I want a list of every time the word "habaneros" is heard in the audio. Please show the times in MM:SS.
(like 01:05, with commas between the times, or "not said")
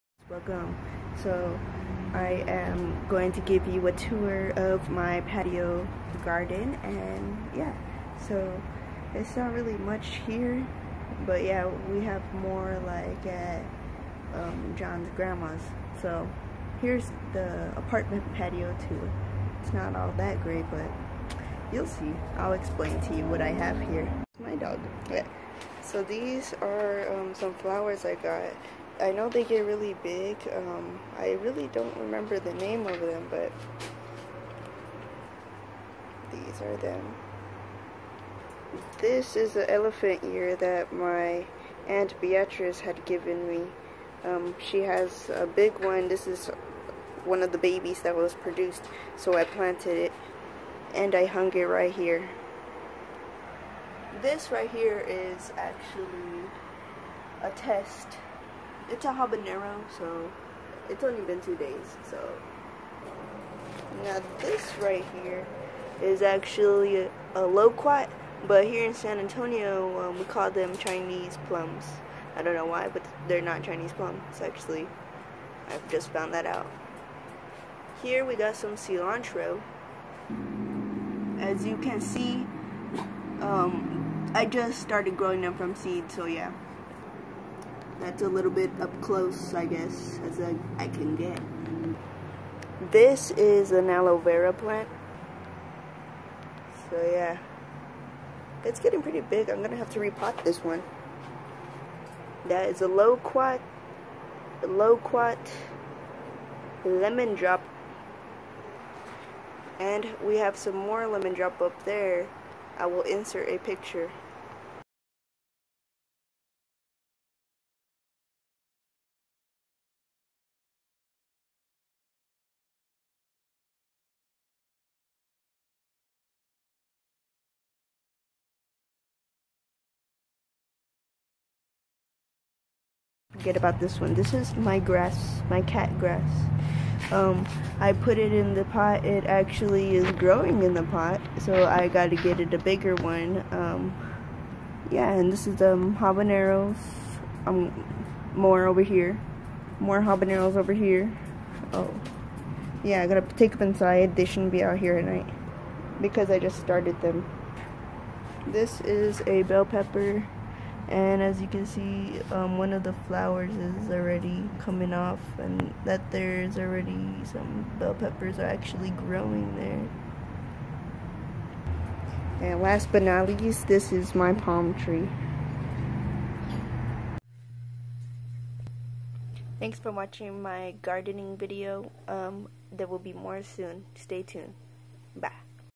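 00:59, 02:25, 02:30.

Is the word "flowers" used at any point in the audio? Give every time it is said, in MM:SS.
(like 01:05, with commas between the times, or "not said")
00:27, 02:43.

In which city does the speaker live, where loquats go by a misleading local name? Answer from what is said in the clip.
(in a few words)
San Antonio.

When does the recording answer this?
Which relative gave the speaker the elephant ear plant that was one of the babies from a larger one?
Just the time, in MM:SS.
00:41.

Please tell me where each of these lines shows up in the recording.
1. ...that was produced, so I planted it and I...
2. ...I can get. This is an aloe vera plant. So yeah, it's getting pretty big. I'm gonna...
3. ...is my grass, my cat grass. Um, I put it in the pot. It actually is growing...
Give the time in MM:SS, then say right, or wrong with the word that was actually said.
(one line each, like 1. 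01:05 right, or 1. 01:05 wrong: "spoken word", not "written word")
1. 00:48 right
2. 01:30 right
3. 02:14 right.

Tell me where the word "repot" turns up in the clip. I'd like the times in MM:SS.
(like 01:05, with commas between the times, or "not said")
01:39.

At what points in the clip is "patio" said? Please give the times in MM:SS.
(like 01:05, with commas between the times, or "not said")
00:05, 00:18.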